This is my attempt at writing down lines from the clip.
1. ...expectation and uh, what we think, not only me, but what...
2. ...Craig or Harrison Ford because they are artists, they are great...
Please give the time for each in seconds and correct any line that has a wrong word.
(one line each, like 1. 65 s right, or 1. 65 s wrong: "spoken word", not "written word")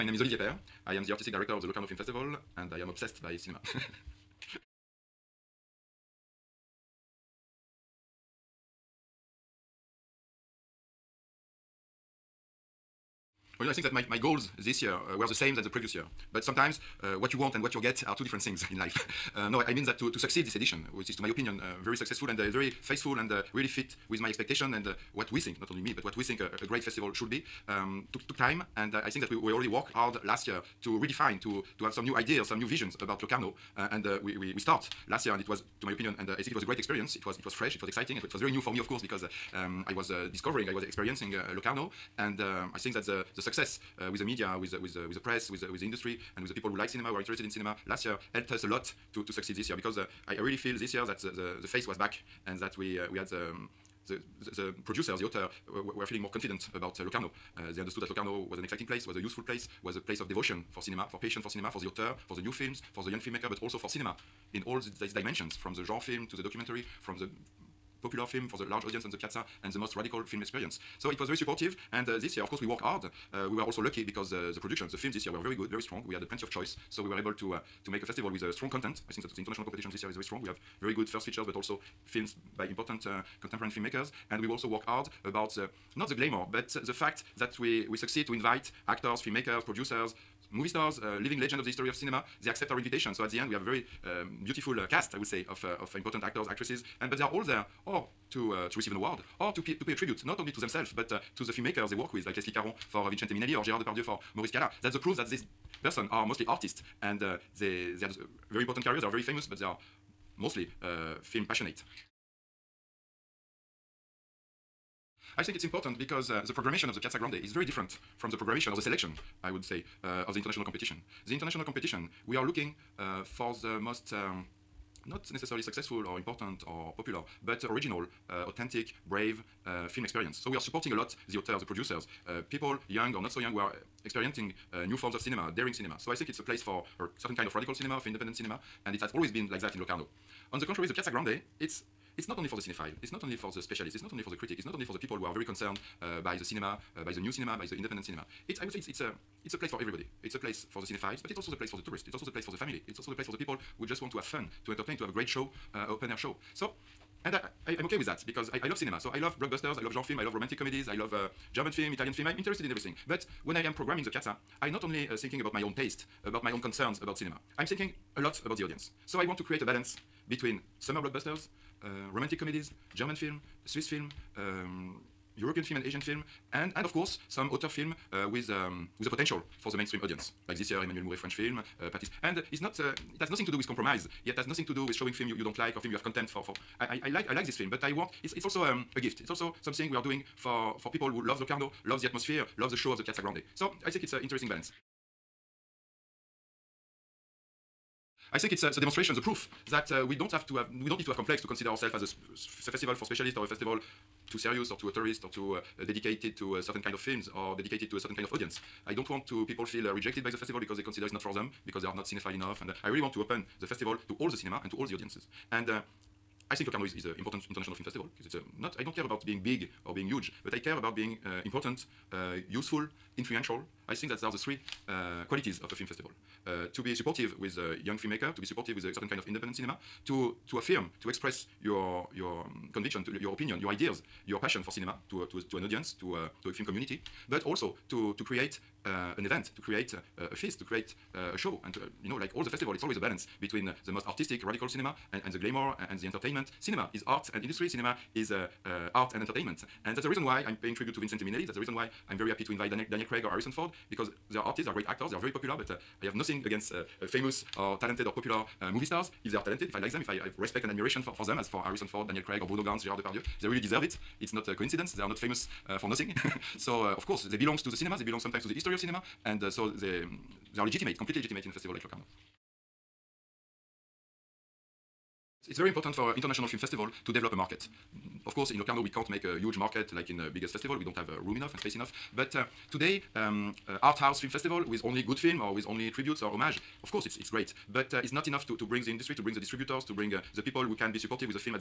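1. 24 s right
2. 253 s right.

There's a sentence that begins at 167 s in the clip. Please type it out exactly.
I'm thinking a lot about the audience.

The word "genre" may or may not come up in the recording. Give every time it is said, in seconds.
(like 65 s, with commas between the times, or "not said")
65 s, 159 s.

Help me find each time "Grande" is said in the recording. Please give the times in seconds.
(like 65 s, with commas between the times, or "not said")
117 s, 141 s, 193 s.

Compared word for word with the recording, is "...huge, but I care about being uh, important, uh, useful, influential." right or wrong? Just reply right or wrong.
right.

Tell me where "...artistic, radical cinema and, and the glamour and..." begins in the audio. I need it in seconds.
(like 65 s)
244 s.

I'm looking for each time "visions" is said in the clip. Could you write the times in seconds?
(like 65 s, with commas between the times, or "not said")
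32 s.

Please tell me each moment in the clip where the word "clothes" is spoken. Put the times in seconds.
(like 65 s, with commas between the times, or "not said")
not said.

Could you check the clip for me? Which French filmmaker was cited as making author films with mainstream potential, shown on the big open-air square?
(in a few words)
Emmanuel Mouret.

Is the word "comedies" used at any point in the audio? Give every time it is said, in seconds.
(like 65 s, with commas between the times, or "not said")
160 s, 172 s.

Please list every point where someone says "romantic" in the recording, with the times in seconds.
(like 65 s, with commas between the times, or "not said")
160 s, 172 s.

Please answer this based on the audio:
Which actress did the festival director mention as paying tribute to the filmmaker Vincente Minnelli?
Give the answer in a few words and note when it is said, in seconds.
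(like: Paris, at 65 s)
Leslie Caron, at 102 s.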